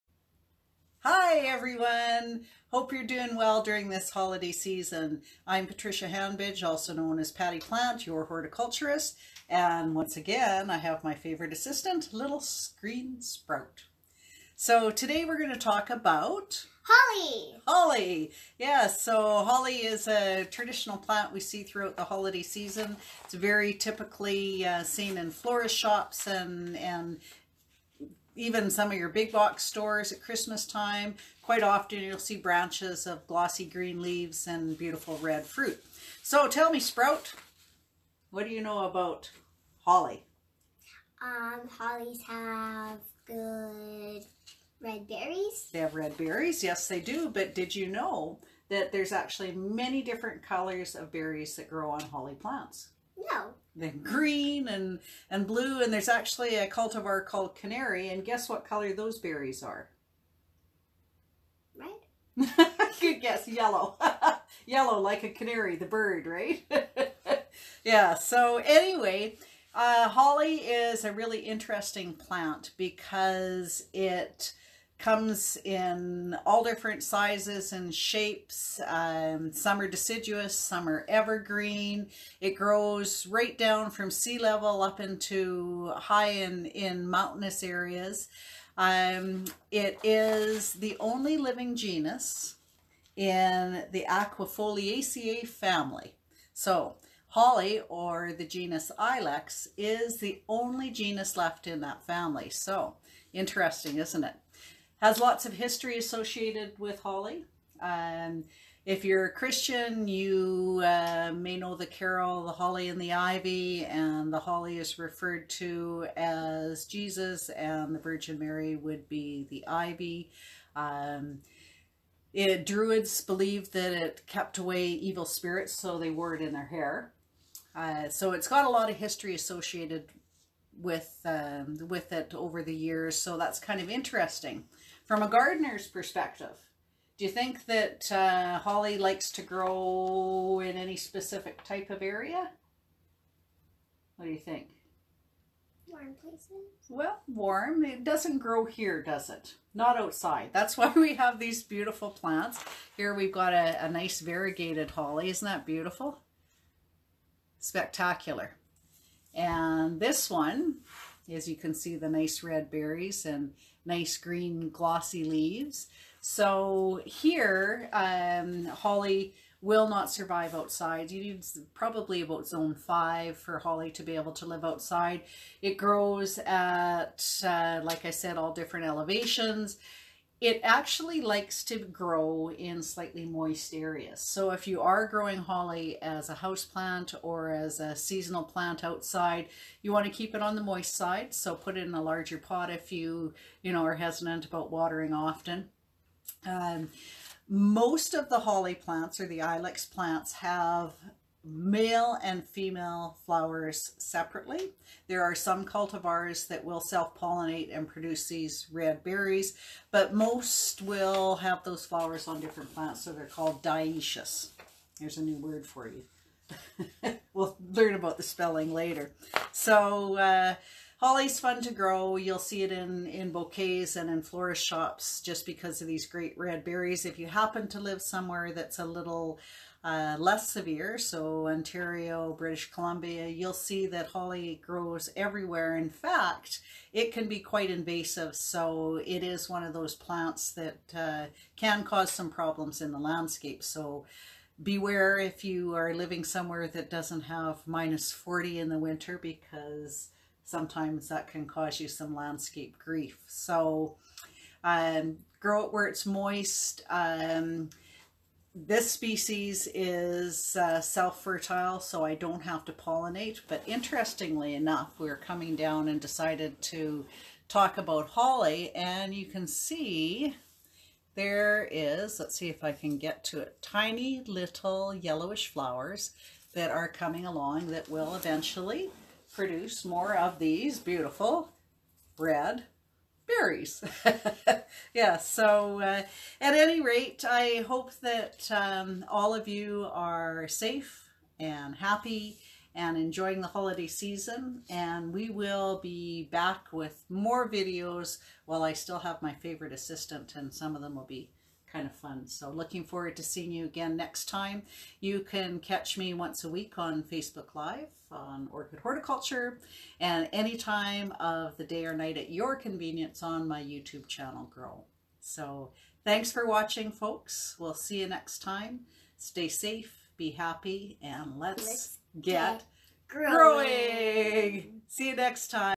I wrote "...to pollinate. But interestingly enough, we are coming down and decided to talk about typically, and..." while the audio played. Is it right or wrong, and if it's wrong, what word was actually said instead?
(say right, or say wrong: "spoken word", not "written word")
wrong: "holly", not "typically".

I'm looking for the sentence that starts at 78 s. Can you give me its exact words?
Um, some are deciduous, some are evergreen.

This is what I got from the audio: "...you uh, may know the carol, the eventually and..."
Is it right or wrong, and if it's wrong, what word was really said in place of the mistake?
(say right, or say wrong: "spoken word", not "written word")
wrong: "holly", not "eventually".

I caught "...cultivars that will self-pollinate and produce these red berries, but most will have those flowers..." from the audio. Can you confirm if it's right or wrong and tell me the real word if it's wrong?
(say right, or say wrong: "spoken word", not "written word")
right.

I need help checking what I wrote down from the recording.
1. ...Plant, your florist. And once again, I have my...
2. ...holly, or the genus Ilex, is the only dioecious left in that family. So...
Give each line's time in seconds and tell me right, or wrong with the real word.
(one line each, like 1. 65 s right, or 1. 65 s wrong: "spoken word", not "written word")
1. 7 s wrong: "horticulturist", not "florist"
2. 97 s wrong: "genus", not "dioecious".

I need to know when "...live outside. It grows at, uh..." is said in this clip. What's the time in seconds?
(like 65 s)
174 s.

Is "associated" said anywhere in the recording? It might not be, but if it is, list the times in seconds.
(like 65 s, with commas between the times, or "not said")
105 s, 129 s.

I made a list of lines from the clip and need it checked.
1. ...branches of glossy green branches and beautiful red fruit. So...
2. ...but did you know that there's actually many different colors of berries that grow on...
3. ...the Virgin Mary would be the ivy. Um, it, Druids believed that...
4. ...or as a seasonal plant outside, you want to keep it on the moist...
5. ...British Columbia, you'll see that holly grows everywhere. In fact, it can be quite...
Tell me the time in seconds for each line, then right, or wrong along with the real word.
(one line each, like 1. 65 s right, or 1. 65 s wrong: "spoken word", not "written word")
1. 32 s wrong: "leaves", not "branches"
2. 47 s right
3. 117 s right
4. 187 s right
5. 232 s right.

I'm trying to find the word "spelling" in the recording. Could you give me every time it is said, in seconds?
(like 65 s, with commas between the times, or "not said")
218 s.